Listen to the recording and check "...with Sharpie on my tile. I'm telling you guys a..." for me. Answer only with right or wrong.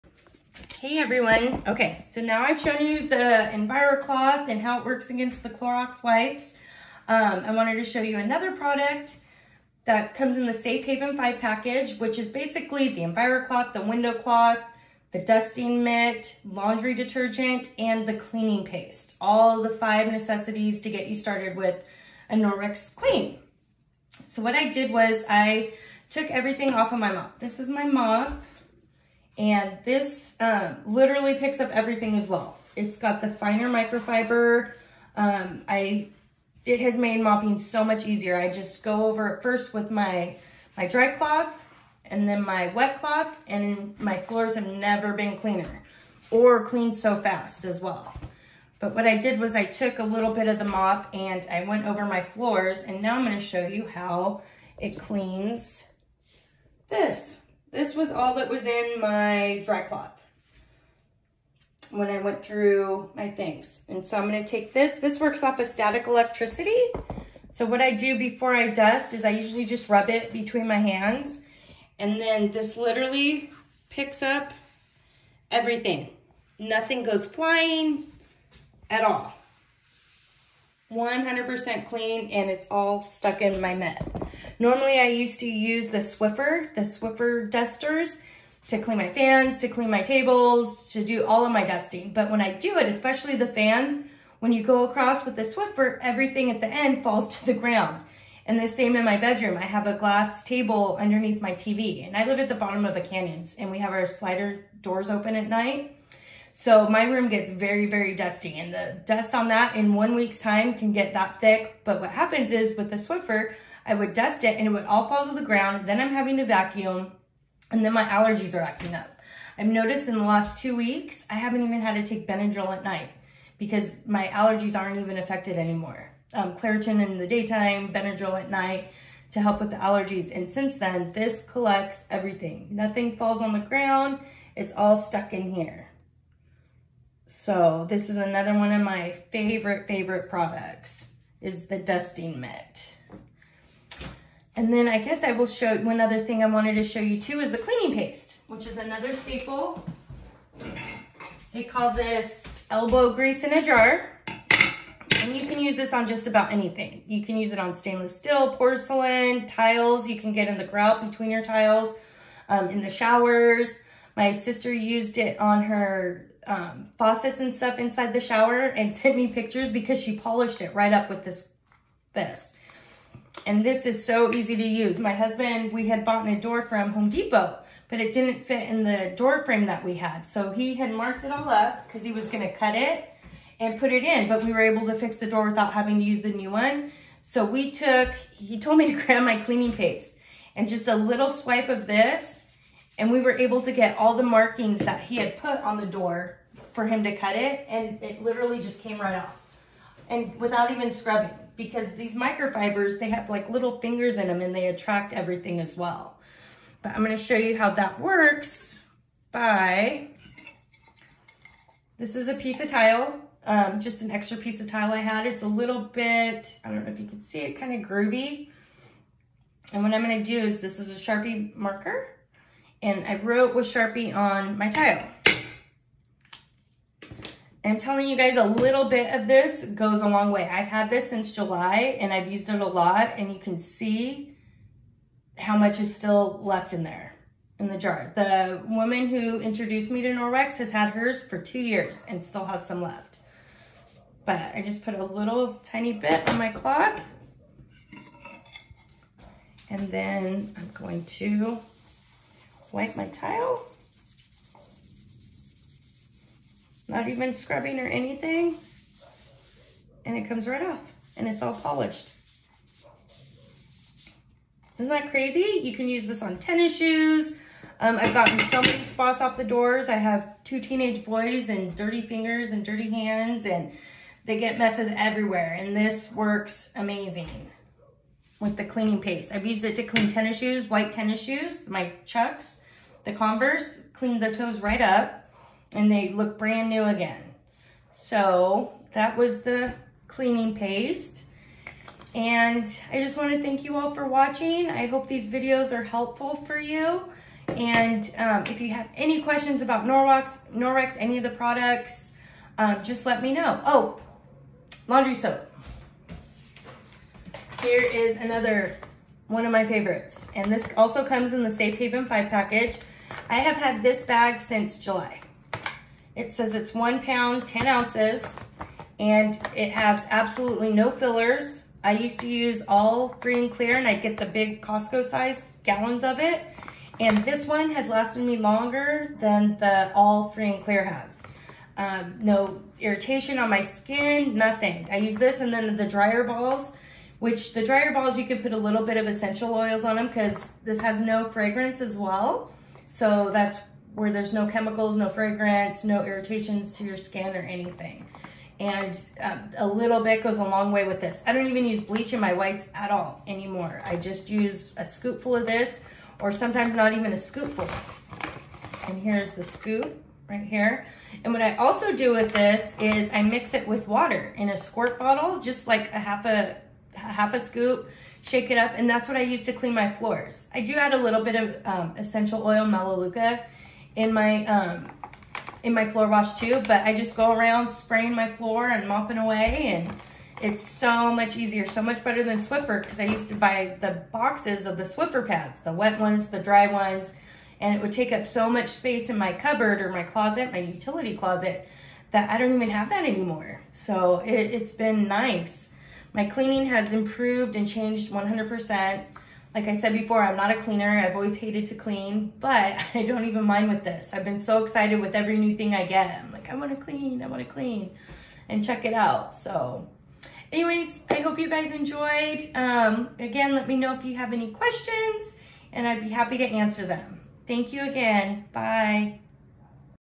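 right.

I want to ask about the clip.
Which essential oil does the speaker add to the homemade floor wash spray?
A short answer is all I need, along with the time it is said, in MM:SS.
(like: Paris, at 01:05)
Melaleuca, at 06:12.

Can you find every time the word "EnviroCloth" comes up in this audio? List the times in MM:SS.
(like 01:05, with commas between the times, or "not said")
00:03, 00:13.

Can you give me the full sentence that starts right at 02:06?
Um, Claritin in the daytime, Benadryl at night to help with the allergies.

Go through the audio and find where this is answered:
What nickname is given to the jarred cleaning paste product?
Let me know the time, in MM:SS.
02:32.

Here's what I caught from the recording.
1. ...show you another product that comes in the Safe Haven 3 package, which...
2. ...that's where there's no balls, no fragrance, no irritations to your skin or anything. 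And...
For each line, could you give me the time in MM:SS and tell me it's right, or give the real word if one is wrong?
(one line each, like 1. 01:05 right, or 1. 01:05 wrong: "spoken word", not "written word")
1. 00:07 wrong: "5", not "3"
2. 05:43 wrong: "chemicals", not "balls".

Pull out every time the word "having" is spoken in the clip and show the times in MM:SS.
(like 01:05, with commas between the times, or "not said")
01:56, 03:05.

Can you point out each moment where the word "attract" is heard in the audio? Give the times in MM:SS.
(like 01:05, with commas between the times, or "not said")
03:24.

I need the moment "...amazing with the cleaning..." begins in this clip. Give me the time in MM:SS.
04:36.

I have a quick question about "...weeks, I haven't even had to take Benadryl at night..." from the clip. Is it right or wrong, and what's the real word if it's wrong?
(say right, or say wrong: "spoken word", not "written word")
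right.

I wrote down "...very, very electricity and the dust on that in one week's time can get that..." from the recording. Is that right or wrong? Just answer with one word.
wrong.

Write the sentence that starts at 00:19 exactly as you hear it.
All the five necessities to get you started with a Norwex clean.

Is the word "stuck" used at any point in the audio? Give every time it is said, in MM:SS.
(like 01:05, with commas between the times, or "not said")
01:23, 02:14.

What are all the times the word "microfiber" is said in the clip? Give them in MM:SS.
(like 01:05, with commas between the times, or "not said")
00:33, 03:22.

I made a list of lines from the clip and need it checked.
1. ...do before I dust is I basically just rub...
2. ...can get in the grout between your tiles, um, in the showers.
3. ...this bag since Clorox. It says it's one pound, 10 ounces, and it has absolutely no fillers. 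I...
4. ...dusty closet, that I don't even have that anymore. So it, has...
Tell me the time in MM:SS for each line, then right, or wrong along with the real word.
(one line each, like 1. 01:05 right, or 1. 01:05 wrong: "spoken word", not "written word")
1. 01:07 wrong: "usually", not "basically"
2. 02:40 right
3. 05:13 wrong: "July", not "Clorox"
4. 06:30 wrong: "utility", not "dusty".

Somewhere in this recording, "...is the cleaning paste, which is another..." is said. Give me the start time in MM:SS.
02:27.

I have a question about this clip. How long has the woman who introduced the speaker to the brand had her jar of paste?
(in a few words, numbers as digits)
2 years.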